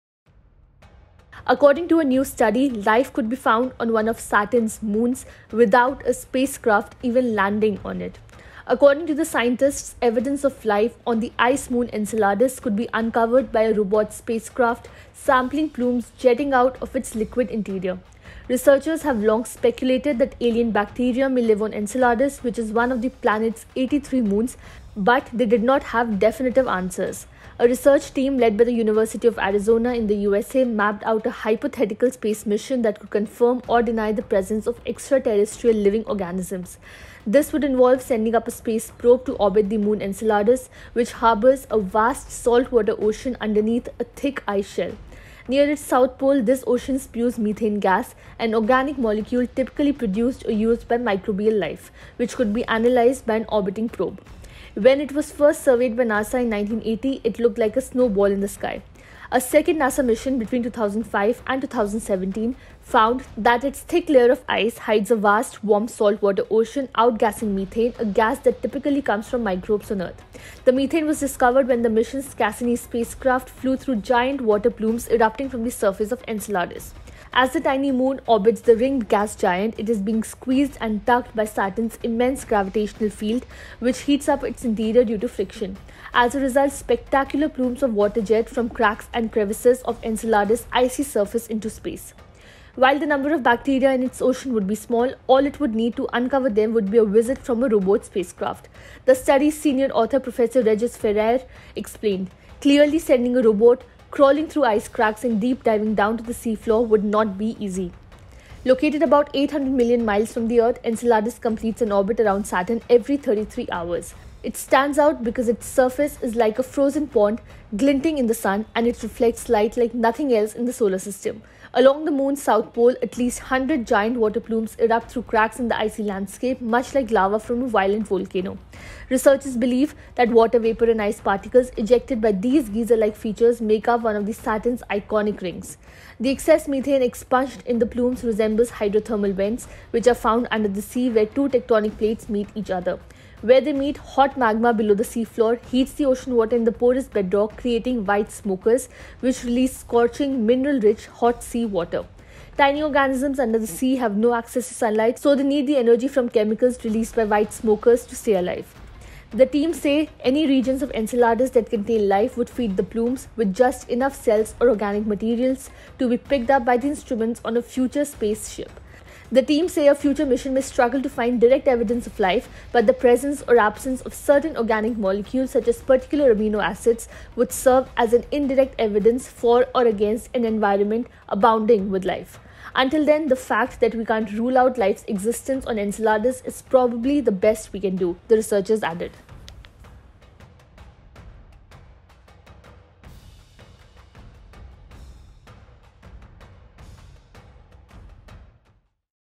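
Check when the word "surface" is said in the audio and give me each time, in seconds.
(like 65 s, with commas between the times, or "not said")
75 s, 91 s, 115 s.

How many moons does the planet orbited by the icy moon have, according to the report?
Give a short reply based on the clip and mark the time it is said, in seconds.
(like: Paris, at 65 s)
83, at 23 s.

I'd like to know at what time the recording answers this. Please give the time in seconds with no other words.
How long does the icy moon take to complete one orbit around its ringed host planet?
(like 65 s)
113 s.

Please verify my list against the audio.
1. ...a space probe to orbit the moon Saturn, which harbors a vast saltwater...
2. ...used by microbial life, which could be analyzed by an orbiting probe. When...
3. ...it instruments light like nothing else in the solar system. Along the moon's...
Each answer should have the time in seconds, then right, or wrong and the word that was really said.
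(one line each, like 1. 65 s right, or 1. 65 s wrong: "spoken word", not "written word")
1. 38 s wrong: "Enceladus", not "Saturn"
2. 50 s right
3. 118 s wrong: "reflects", not "instruments".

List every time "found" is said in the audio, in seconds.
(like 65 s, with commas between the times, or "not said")
3 s, 62 s, 140 s.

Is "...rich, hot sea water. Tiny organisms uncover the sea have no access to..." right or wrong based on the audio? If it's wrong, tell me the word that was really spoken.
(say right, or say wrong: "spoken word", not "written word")
wrong: "under", not "uncover".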